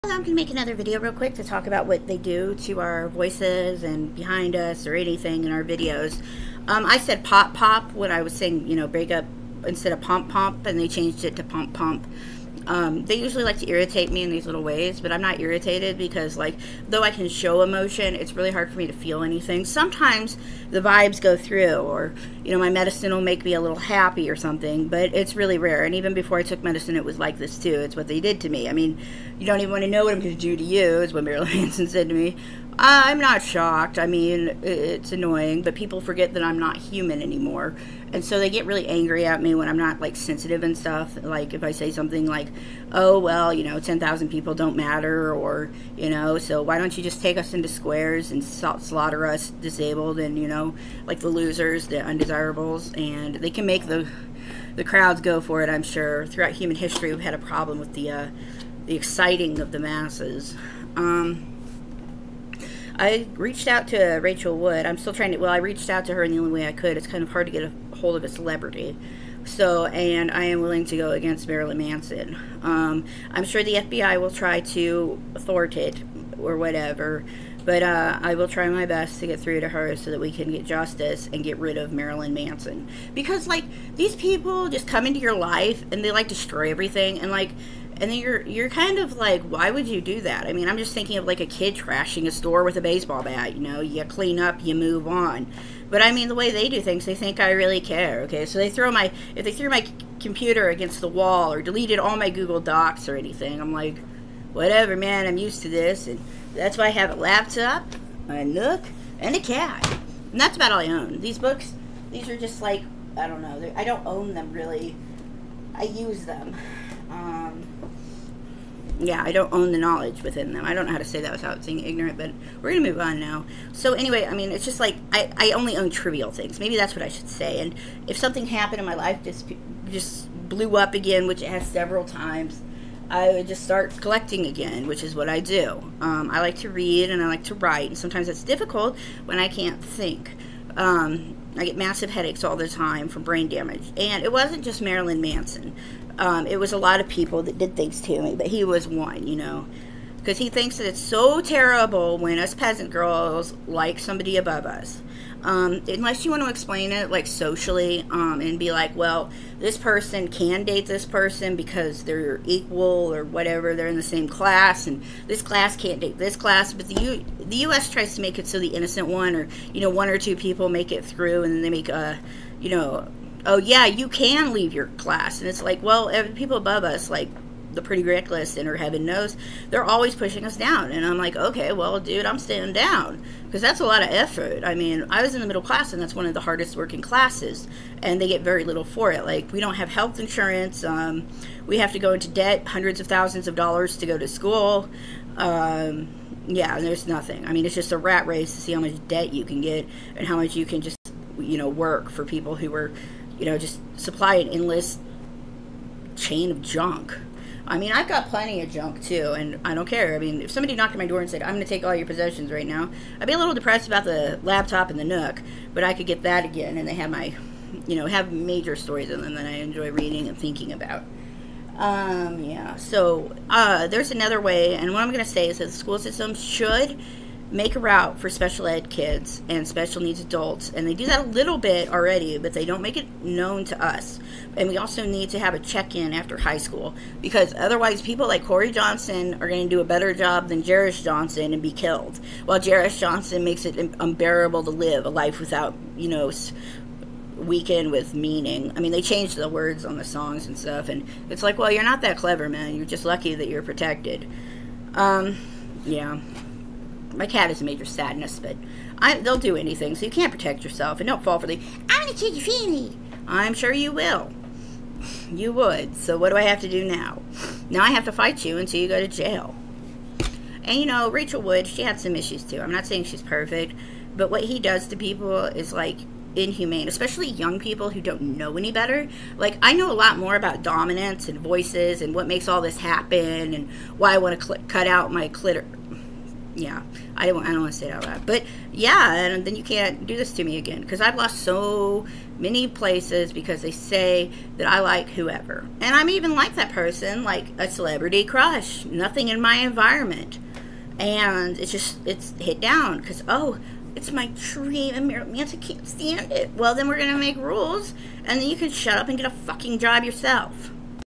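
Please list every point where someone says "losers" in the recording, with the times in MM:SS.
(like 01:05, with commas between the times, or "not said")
00:51.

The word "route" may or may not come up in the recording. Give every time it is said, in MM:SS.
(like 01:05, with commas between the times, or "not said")
03:47.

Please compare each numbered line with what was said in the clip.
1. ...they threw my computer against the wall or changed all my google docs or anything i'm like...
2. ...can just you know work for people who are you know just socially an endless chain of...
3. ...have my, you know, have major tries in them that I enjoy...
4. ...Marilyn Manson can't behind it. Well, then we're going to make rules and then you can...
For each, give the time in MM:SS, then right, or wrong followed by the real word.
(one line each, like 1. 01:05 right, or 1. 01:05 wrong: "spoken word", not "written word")
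1. 01:39 wrong: "deleted", not "changed"
2. 03:20 wrong: "supply", not "socially"
3. 03:36 wrong: "stories", not "tries"
4. 05:05 wrong: "stand", not "behind".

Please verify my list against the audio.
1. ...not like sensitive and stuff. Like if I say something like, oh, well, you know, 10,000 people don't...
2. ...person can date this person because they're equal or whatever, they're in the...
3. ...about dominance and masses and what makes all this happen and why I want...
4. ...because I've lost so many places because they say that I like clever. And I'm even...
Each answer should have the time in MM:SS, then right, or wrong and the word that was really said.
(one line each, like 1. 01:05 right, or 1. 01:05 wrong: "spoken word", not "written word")
1. 00:39 right
2. 02:39 right
3. 04:40 wrong: "voices", not "masses"
4. 04:50 wrong: "whoever", not "clever".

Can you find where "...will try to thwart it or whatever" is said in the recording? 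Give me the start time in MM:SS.
01:14.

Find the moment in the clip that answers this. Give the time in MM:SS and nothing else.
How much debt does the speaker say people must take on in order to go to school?
03:12.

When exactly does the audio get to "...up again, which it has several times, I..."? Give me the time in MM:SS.
02:10.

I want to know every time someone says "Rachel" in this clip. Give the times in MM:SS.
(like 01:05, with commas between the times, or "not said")
01:04, 04:31.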